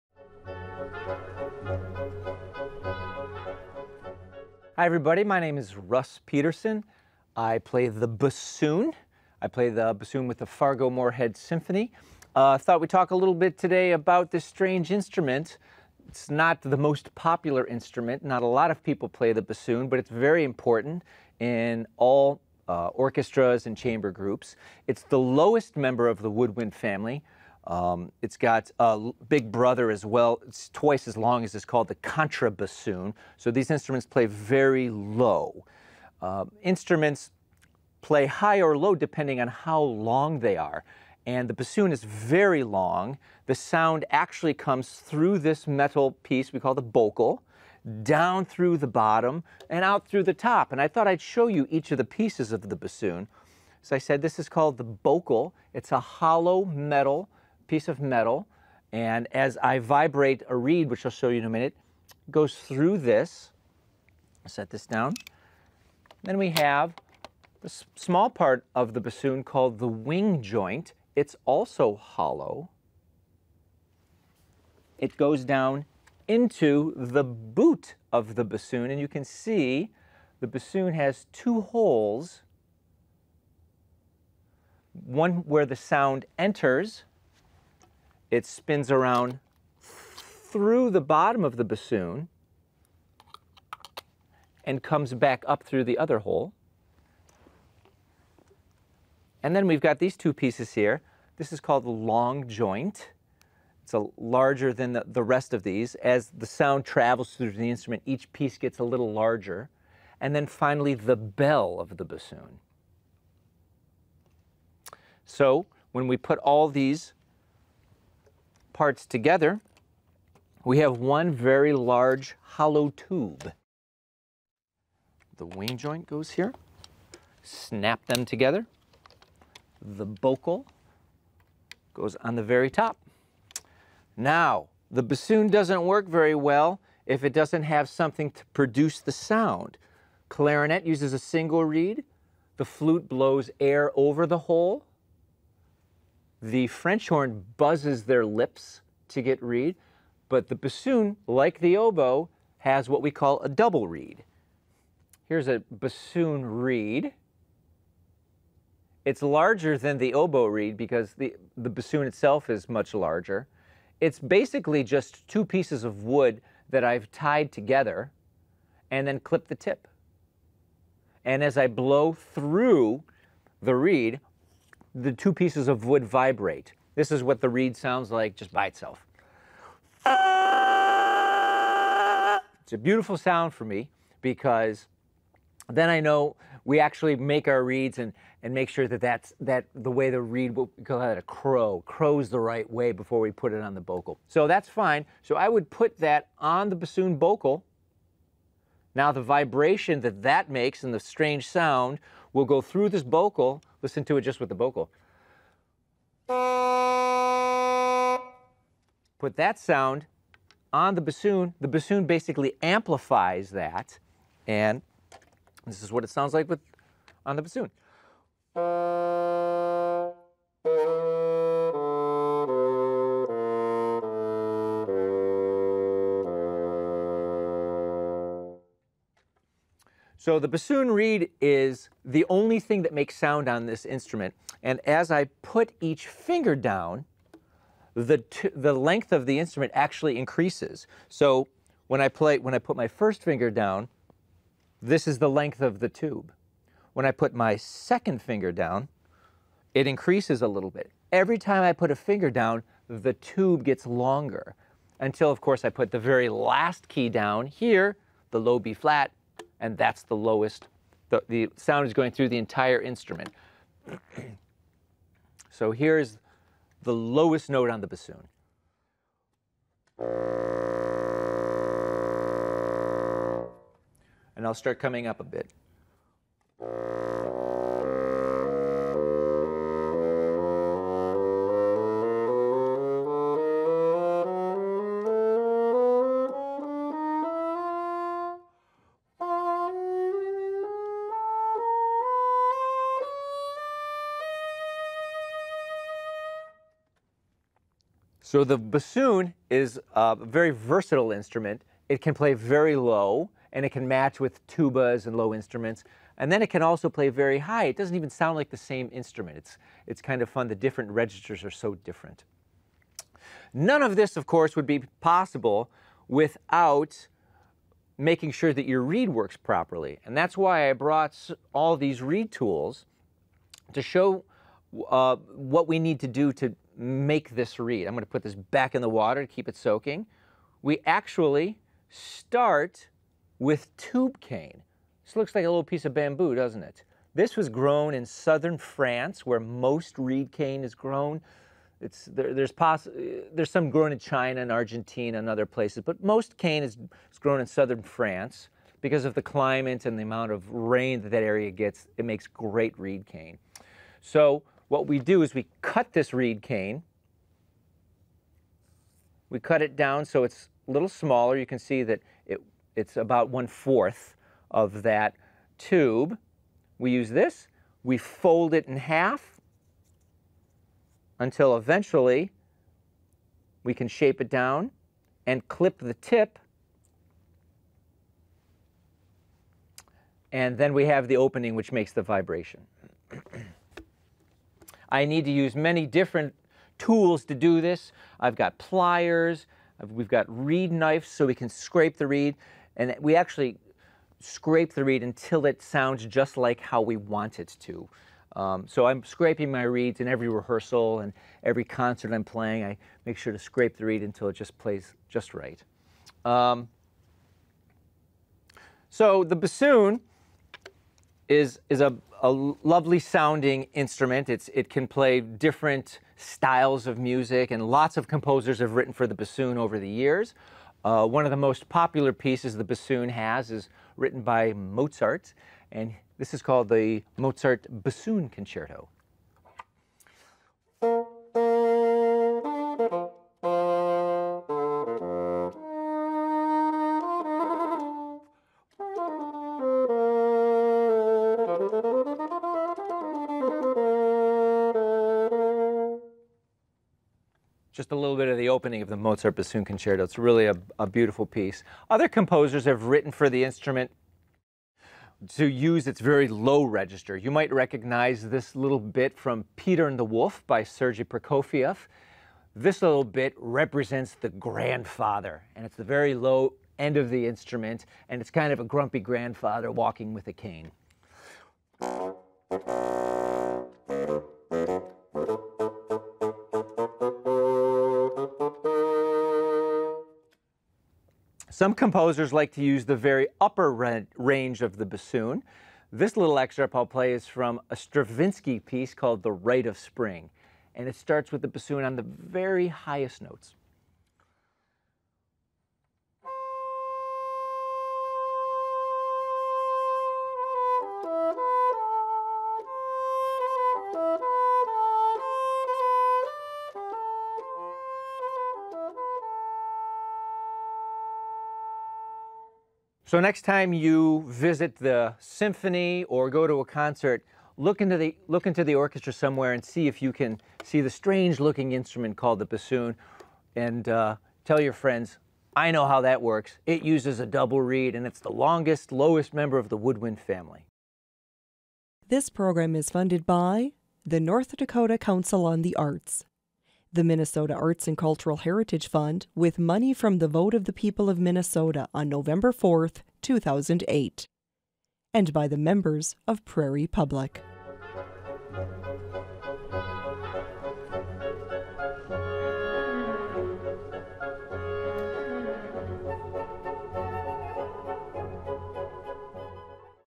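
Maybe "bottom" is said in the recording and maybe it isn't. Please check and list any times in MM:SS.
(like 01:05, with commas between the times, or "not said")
00:48, 01:31.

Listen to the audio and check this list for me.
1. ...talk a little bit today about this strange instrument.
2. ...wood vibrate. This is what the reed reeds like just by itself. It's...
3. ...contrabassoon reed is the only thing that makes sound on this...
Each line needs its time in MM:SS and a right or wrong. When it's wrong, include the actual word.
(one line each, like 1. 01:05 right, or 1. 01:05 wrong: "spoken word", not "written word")
1. 00:12 right
2. 02:55 wrong: "sounds", not "reeds"
3. 03:50 wrong: "bassoon", not "contrabassoon".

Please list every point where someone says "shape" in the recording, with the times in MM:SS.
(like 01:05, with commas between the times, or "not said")
06:13.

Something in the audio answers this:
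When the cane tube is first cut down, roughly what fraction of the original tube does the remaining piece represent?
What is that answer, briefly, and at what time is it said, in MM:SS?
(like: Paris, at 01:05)
one-fourth, at 06:03.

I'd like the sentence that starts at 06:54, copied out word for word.
It's, it can play different styles of music, and lots of composers have written for the bassoon over the years.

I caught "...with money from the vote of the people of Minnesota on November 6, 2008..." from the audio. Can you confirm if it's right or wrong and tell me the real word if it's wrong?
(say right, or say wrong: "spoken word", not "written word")
wrong: "4", not "6".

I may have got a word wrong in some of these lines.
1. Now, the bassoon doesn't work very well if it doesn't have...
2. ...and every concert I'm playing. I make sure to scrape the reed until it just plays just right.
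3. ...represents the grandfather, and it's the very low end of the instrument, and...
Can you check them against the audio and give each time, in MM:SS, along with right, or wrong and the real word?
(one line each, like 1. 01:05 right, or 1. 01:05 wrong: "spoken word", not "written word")
1. 02:14 right
2. 06:40 right
3. 07:43 right.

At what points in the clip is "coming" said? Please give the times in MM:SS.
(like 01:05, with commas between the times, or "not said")
04:34.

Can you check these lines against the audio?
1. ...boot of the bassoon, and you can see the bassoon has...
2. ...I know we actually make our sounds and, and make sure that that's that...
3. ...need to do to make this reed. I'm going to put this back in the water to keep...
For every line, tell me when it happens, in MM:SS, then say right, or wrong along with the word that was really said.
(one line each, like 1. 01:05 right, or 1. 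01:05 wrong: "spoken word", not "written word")
1. 01:17 right
2. 03:05 wrong: "reeds", not "sounds"
3. 05:25 right.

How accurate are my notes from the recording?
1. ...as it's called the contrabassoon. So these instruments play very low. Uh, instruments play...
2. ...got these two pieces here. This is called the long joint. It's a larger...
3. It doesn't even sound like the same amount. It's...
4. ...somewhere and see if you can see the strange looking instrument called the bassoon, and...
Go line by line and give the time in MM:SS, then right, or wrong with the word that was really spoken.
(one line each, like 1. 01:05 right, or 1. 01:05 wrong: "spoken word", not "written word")
1. 00:31 right
2. 01:39 right
3. 05:07 wrong: "instrument", not "amount"
4. 08:39 right.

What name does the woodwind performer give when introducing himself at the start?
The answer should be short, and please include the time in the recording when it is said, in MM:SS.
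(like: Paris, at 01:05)
Russ Peterson, at 00:05.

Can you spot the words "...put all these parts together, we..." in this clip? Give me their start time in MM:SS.
01:56.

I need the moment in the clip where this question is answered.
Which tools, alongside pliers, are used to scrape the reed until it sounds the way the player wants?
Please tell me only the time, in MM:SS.
06:30.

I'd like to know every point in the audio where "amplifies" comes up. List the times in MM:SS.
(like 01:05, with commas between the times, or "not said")
03:32.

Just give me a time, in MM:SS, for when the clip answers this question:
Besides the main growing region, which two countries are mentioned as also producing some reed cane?
05:43.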